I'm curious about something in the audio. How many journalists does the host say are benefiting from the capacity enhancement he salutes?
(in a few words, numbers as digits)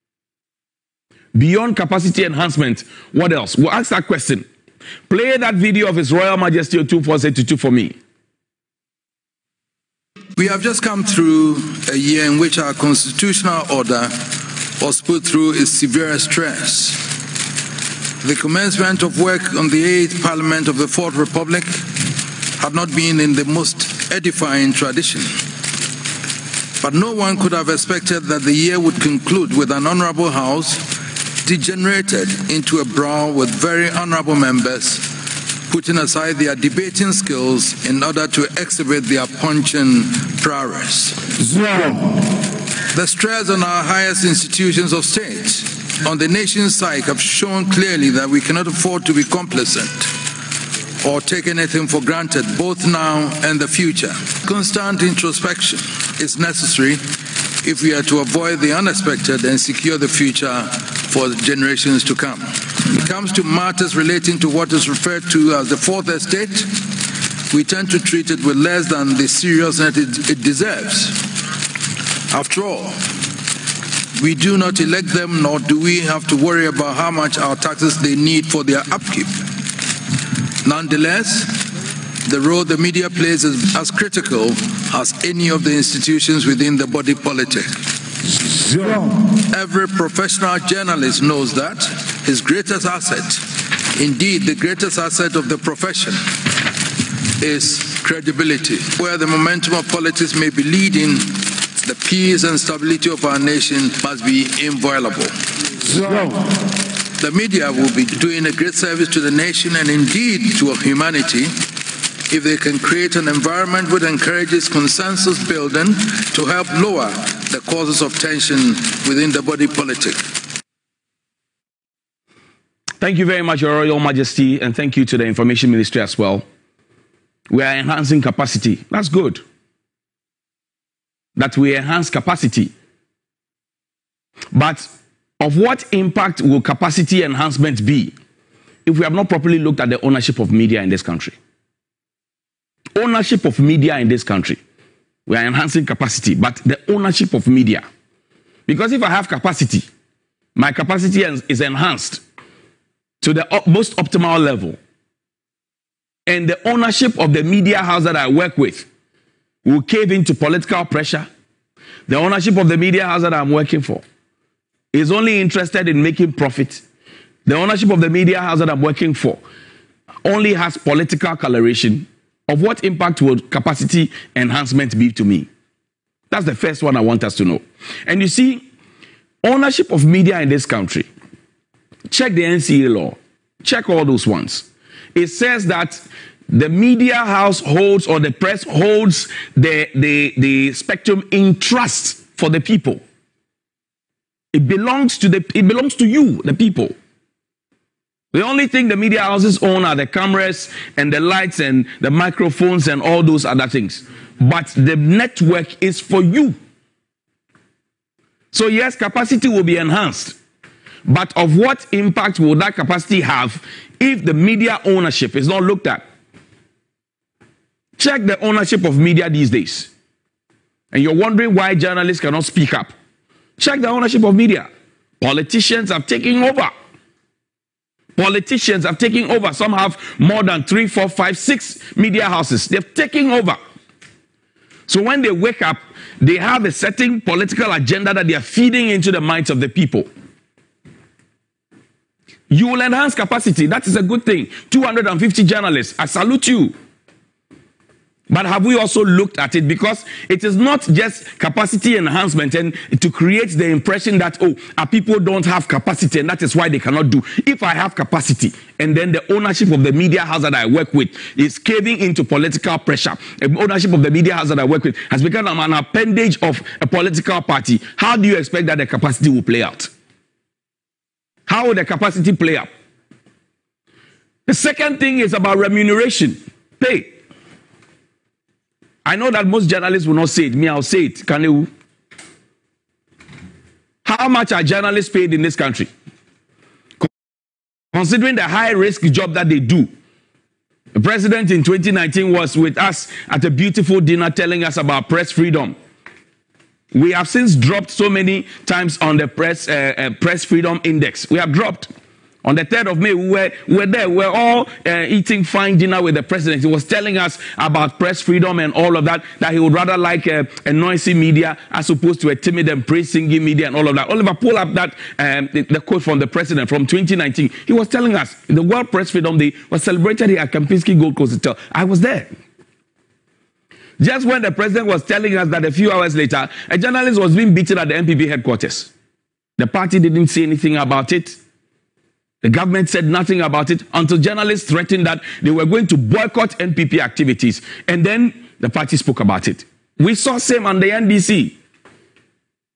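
250.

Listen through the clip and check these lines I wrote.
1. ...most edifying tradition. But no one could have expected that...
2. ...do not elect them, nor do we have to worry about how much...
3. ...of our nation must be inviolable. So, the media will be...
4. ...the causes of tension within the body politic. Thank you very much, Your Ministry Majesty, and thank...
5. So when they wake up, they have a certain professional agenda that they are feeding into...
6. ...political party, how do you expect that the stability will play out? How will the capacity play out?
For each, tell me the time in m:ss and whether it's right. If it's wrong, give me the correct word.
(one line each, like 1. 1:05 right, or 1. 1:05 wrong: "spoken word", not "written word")
1. 0:23 right
2. 1:14 right
3. 1:43 right
4. 1:57 wrong: "Royal", not "Ministry"
5. 3:54 wrong: "political", not "professional"
6. 4:26 wrong: "capacity", not "stability".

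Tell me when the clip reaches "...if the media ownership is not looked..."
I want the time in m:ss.
3:34.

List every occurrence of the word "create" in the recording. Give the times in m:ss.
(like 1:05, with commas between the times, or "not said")
1:52, 4:13.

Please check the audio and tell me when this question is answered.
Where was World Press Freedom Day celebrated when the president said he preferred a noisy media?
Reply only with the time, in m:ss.
5:20.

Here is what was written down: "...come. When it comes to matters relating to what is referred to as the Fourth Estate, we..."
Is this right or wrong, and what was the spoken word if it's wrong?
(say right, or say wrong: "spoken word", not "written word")
right.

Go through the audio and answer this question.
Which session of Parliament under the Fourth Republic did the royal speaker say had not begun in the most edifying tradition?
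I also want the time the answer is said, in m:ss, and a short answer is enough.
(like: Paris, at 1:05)
Eighth Parliament, at 0:19.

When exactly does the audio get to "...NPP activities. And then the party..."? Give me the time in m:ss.
5:36.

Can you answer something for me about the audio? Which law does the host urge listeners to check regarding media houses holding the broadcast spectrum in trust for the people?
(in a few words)
NCA law.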